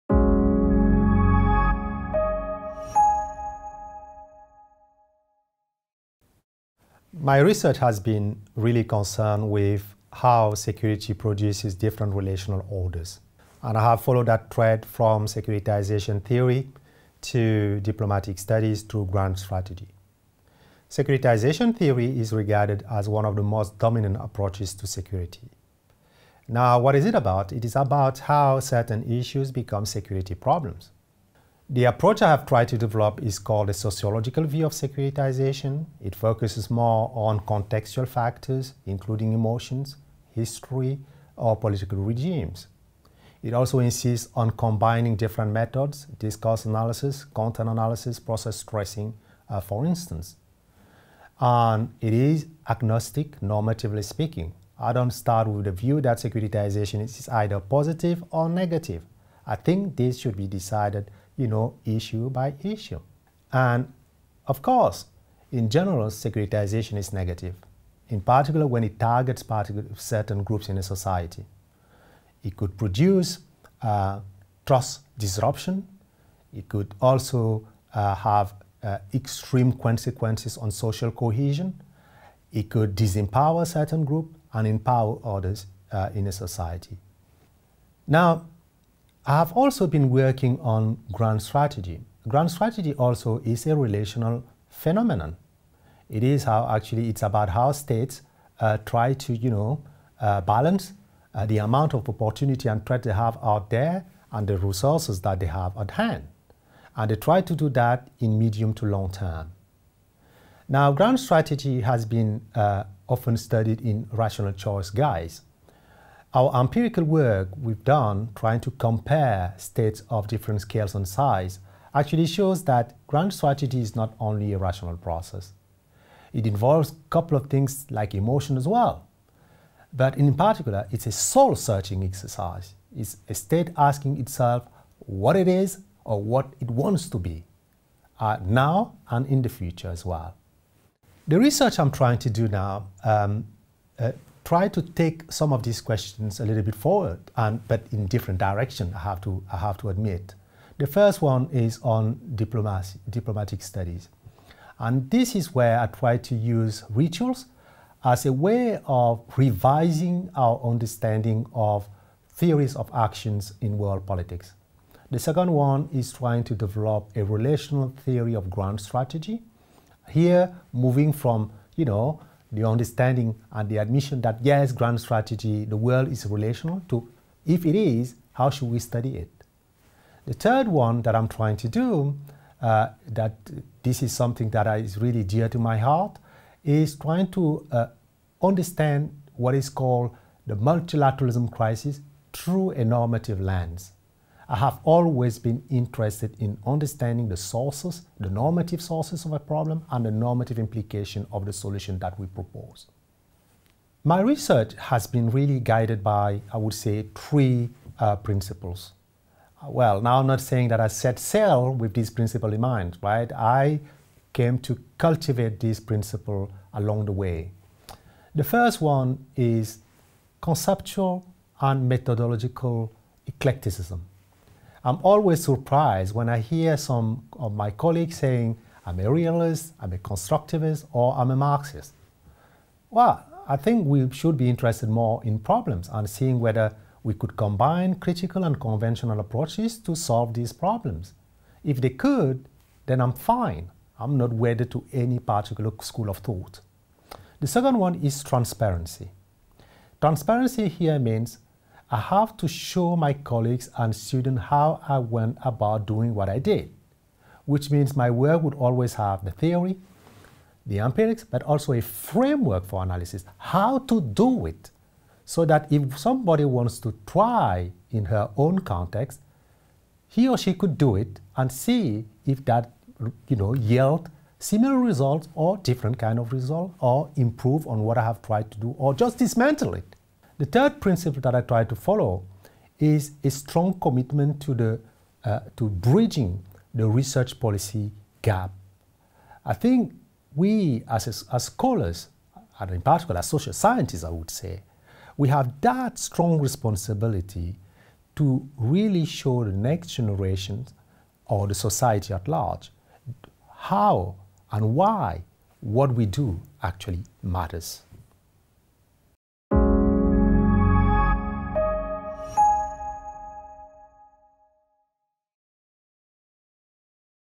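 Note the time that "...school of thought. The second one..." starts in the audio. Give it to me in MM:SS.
04:05.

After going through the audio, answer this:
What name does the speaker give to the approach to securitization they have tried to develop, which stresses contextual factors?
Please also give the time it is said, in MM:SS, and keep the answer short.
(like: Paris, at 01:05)
sociological view, at 00:33.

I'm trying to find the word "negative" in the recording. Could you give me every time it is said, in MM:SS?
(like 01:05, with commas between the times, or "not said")
00:58, 01:07.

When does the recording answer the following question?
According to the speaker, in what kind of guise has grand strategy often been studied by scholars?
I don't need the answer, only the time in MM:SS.
01:54.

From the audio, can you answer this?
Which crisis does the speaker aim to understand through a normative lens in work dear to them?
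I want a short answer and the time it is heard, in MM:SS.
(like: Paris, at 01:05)
multilateralism crisis, at 03:10.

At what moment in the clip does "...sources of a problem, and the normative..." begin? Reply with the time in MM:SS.
03:18.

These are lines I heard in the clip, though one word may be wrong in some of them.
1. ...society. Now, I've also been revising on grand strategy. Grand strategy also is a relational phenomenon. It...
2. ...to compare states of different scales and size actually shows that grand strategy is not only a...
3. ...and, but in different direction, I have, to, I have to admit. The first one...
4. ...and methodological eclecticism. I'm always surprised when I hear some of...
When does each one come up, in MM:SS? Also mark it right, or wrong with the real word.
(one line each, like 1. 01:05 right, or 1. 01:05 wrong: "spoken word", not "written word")
1. 01:26 wrong: "working", not "revising"
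2. 01:58 right
3. 02:27 right
4. 03:41 right.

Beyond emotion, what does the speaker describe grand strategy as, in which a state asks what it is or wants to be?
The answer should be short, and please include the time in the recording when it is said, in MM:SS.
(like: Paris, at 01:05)
soul searching exercise, at 02:11.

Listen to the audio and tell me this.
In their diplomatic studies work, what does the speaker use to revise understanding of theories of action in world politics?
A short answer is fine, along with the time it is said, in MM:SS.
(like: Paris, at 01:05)
rituals, at 02:36.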